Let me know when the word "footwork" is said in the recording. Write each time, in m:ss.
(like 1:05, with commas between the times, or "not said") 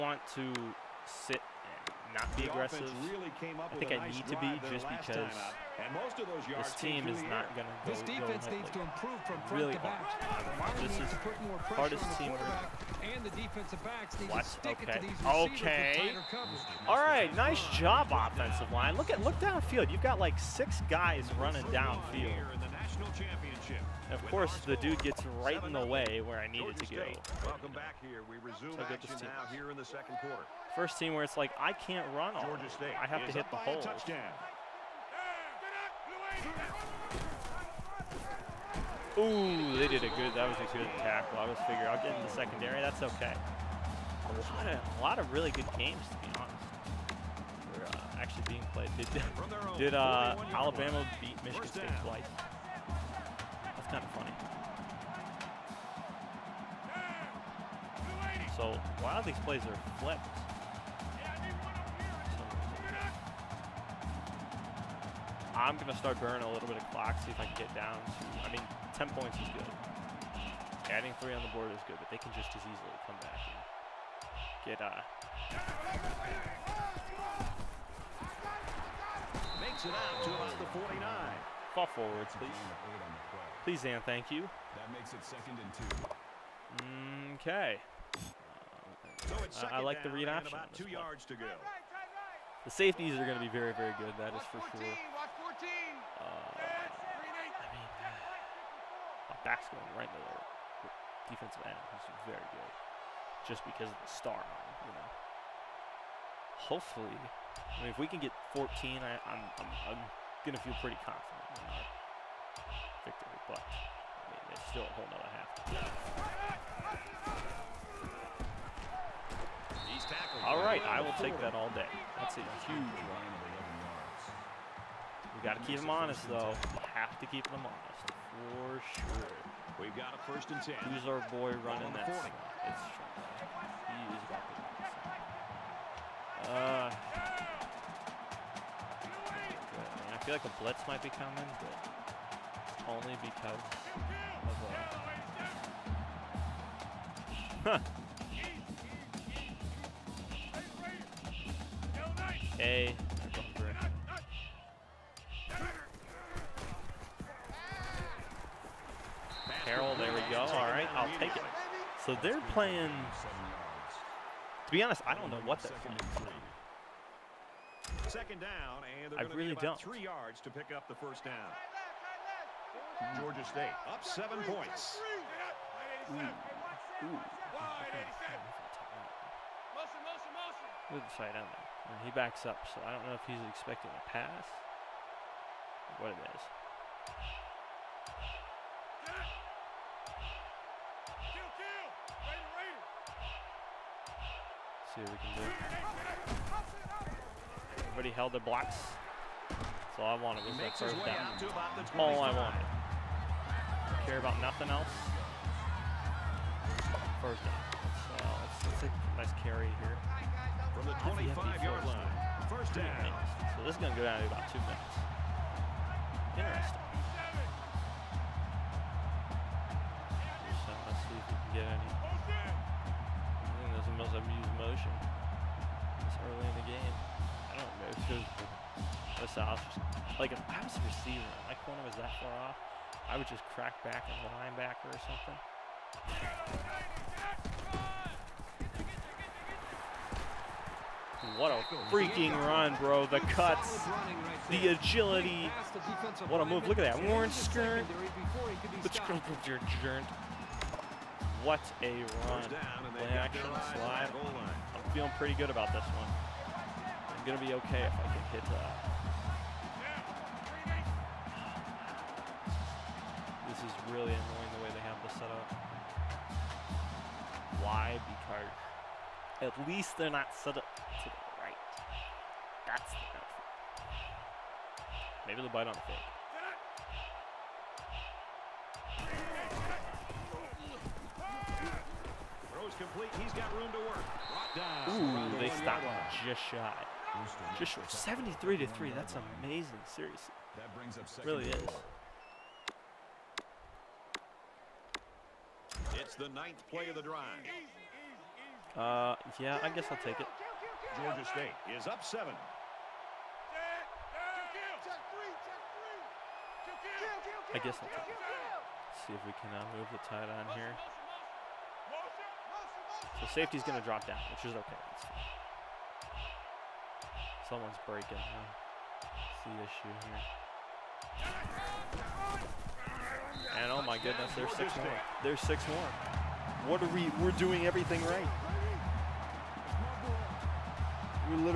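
not said.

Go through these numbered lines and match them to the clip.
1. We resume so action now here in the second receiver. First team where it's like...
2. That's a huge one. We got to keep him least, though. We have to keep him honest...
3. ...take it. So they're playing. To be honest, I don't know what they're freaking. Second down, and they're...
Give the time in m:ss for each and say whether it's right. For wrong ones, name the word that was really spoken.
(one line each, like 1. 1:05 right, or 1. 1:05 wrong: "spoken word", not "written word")
1. 0:28 wrong: "quarter", not "receiver"
2. 2:02 wrong: "honest", not "least"
3. 2:41 wrong: "playing", not "freaking".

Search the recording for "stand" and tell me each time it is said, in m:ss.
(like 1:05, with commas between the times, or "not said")
not said.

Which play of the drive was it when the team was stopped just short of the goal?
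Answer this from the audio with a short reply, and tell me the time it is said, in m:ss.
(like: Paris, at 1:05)
9th, at 4:56.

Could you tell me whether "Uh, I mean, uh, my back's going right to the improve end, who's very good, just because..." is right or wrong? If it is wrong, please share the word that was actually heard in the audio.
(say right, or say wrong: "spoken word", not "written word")
wrong: "defensive", not "improve".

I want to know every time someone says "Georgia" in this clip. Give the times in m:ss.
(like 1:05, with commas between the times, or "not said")
0:32, 2:53, 5:01.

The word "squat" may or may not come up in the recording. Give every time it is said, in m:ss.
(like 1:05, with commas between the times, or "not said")
not said.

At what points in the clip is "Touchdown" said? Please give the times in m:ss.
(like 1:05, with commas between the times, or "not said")
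0:33.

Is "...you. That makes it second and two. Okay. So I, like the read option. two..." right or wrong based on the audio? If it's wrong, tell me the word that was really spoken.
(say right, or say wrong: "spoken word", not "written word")
right.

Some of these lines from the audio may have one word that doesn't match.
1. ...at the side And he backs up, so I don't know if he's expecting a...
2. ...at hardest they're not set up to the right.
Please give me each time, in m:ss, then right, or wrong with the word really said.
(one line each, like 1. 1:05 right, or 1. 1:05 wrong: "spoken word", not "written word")
1. 3:01 right
2. 4:29 wrong: "least", not "hardest".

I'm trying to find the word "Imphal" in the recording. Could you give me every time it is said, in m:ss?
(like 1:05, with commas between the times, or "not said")
not said.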